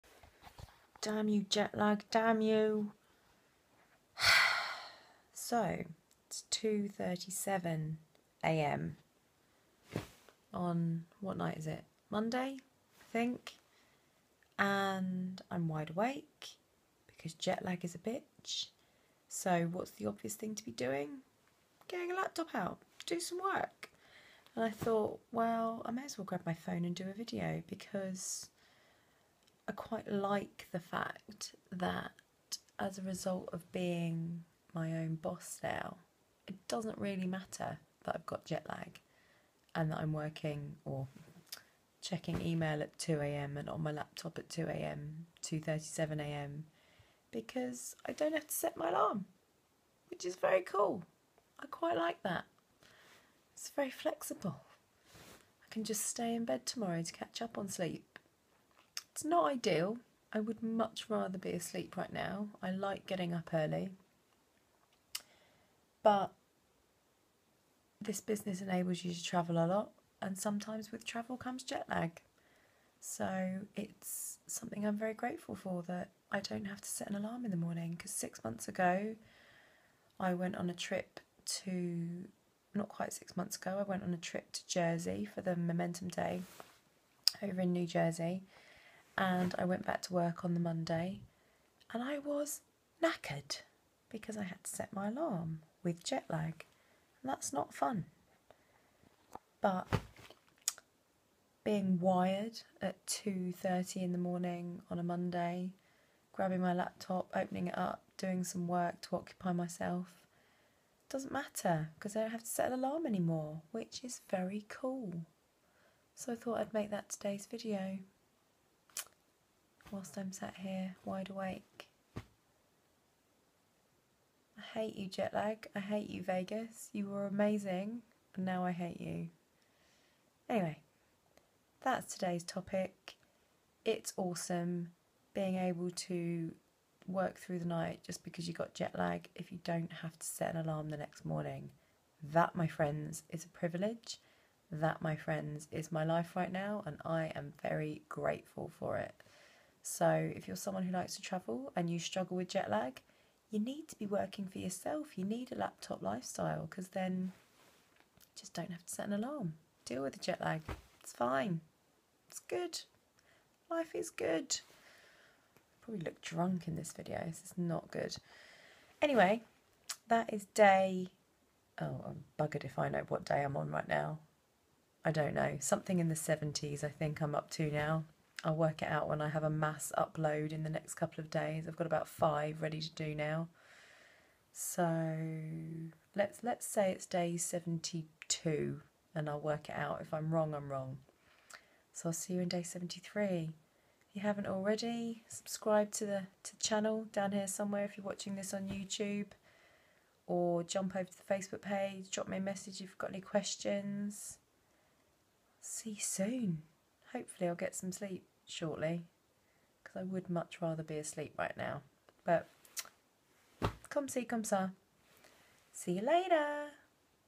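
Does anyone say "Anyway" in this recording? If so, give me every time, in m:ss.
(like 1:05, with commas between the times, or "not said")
2:10, 2:49.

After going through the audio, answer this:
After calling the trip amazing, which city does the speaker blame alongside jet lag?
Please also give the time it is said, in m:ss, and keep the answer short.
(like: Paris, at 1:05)
Vegas, at 2:06.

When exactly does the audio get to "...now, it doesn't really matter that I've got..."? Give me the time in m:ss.
0:35.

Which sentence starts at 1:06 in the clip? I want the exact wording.
But this business enables you to travel a lot, and sometimes with travel comes jet lag.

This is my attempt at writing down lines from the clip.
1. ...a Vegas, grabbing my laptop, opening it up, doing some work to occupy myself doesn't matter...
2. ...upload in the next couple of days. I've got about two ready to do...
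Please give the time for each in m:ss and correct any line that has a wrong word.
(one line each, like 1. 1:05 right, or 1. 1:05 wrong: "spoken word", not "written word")
1. 1:44 wrong: "Monday", not "Vegas"
2. 2:59 wrong: "five", not "two".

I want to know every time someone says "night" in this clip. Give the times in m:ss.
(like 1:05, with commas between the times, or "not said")
0:11, 2:17.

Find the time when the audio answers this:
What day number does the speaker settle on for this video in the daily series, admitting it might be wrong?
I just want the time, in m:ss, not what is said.
3:07.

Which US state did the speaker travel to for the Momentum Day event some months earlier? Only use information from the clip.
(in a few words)
New Jersey.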